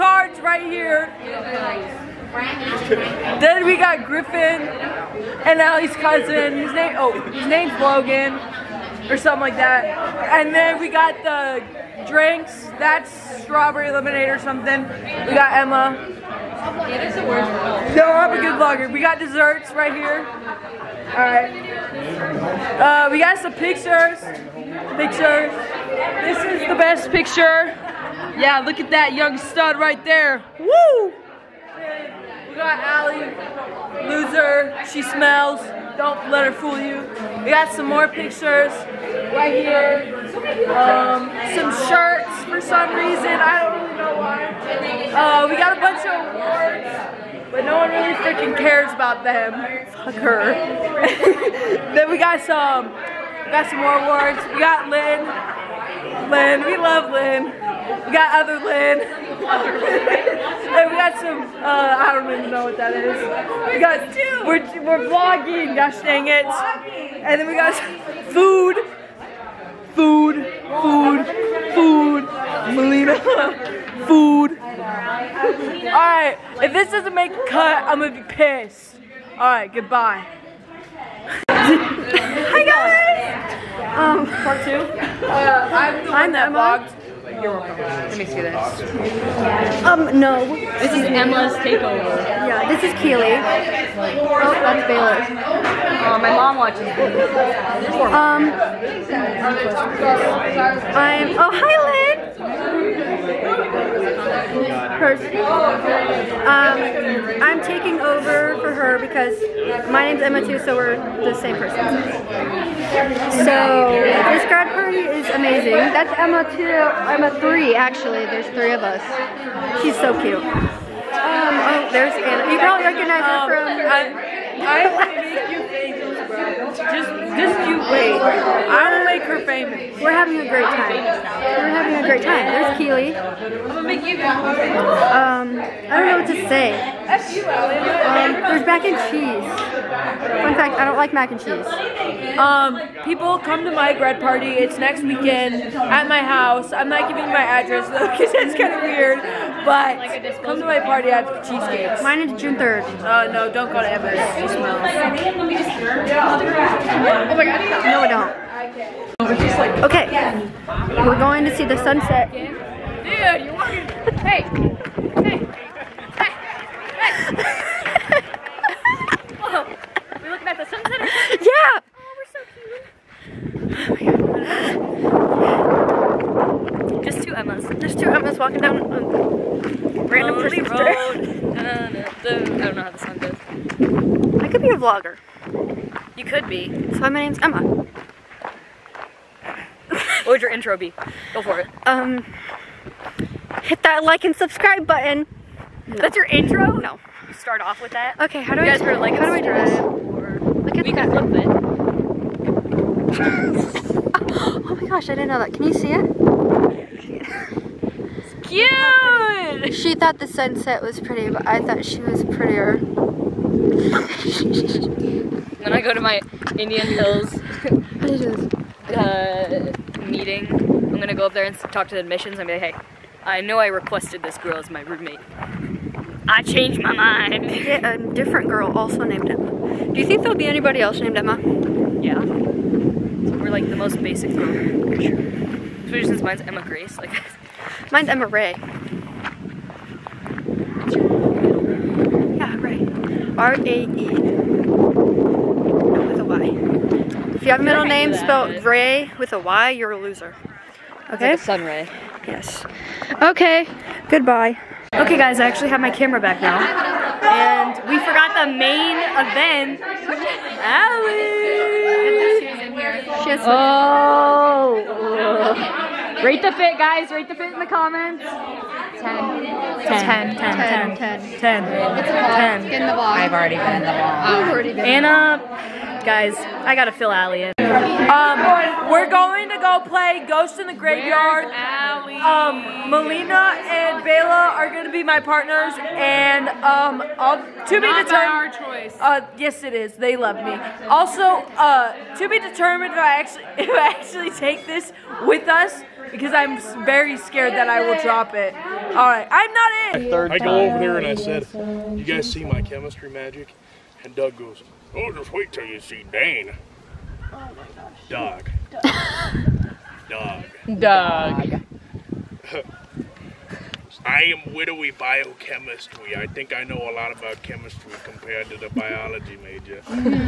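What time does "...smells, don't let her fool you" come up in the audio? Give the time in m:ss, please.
0:35.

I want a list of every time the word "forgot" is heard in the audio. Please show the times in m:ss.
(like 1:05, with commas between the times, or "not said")
4:17.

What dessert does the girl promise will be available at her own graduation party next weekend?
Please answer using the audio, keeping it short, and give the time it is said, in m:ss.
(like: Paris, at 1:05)
Cheesecakes, at 2:31.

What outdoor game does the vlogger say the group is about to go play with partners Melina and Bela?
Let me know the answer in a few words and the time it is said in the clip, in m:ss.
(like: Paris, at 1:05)
Ghost in the Graveyard, at 4:40.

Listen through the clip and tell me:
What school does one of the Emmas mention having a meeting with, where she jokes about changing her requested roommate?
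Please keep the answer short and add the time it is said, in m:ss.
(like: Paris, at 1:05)
Indian Hills, at 3:36.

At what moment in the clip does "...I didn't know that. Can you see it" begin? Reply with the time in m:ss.
3:25.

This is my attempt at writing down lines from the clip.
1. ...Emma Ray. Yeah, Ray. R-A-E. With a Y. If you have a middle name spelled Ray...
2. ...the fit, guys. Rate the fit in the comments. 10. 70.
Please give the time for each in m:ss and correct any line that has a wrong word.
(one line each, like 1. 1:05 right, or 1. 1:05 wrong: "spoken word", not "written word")
1. 3:58 right
2. 4:26 wrong: "10", not "70".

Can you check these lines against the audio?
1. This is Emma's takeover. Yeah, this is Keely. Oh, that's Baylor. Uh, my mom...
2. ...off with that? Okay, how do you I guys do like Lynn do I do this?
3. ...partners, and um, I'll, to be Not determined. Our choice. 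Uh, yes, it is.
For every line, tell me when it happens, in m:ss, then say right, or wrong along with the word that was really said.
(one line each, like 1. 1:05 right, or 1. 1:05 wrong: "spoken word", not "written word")
1. 1:30 right
2. 3:17 wrong: "How", not "Lynn"
3. 4:45 right.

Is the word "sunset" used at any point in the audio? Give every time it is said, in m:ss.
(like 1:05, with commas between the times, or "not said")
2:41, 2:50, 3:30.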